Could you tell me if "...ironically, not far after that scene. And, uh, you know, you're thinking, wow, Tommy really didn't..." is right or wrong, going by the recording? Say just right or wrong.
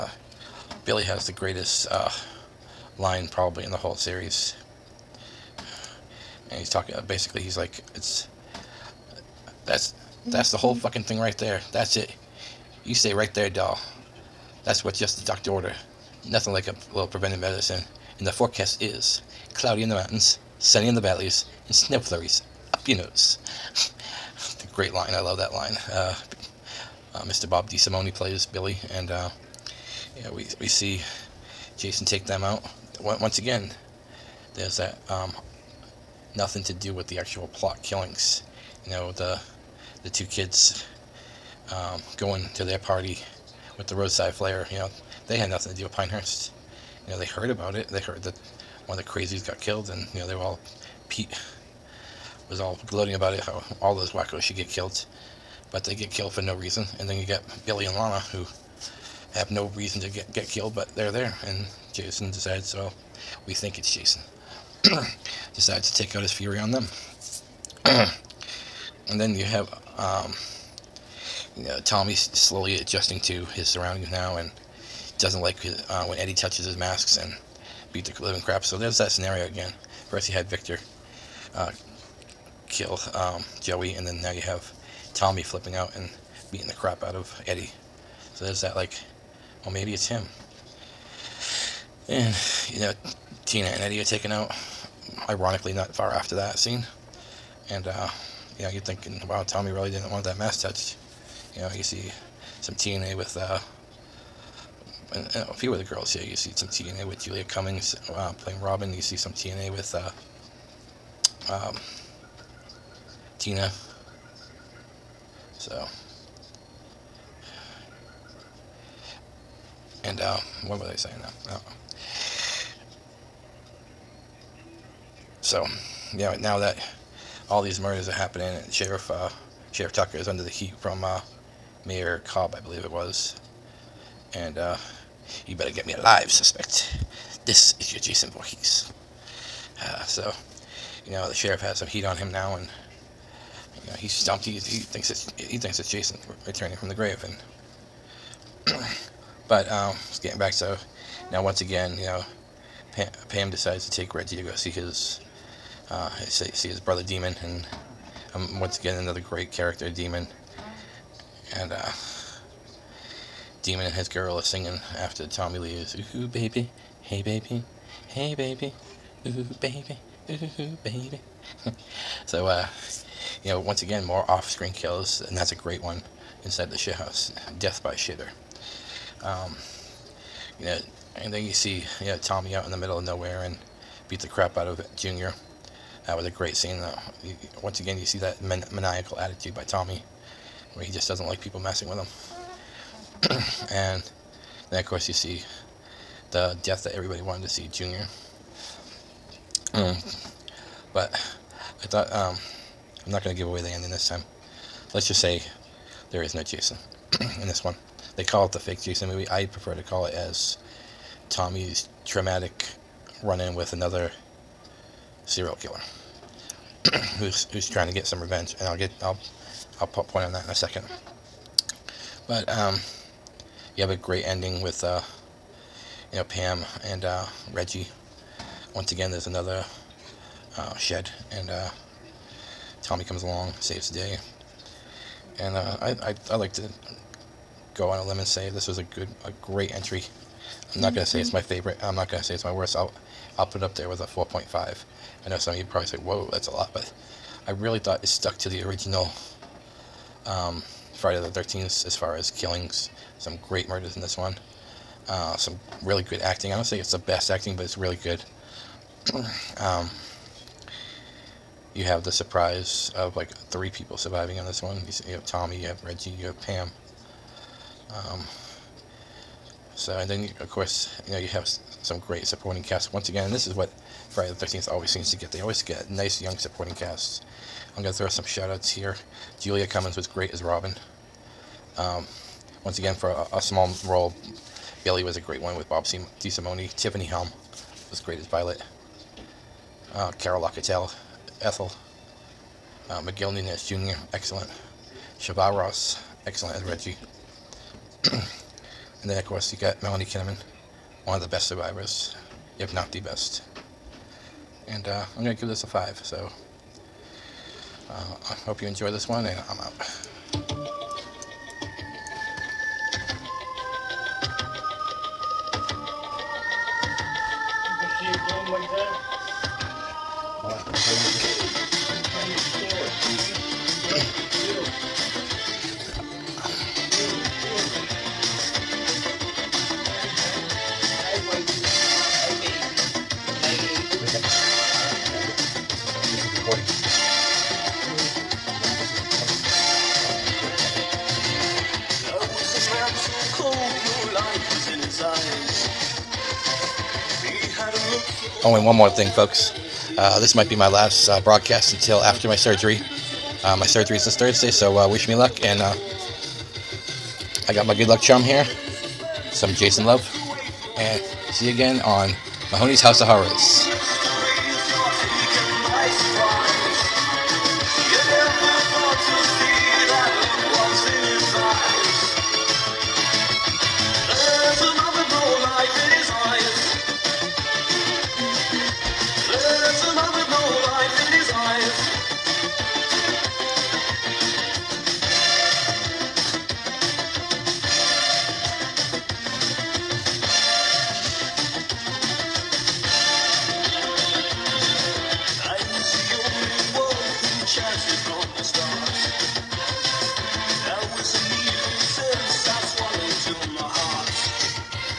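right.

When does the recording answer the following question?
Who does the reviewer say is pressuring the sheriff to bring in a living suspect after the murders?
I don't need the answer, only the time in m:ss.
2:11.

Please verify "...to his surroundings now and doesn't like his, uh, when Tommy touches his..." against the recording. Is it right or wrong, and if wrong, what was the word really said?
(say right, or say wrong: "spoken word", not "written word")
wrong: "Eddie", not "Tommy".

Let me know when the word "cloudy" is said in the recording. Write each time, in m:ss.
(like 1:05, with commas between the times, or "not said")
0:19.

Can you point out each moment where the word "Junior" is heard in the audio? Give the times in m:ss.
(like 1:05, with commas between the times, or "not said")
3:04, 3:17.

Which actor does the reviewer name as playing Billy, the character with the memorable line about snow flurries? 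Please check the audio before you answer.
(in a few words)
Bob DeSimone.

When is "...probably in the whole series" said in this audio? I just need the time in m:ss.
0:03.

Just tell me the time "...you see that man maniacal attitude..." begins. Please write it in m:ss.
3:07.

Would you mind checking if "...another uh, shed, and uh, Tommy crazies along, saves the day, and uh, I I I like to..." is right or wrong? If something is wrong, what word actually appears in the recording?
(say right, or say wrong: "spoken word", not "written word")
wrong: "comes", not "crazies".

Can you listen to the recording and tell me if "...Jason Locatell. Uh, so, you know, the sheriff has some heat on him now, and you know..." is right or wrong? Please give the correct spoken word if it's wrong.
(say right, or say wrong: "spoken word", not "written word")
wrong: "Voorhees", not "Locatell".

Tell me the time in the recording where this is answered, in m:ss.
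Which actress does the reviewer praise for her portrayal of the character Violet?
4:46.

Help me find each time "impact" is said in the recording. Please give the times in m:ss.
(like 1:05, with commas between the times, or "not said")
not said.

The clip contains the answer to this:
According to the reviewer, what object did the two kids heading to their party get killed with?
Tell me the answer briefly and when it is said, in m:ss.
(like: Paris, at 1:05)
roadside flare, at 0:43.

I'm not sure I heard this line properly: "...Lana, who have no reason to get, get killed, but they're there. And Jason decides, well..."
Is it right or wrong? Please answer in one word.
right.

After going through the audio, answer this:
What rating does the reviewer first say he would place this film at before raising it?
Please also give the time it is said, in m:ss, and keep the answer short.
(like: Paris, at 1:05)
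4.5, at 4:04.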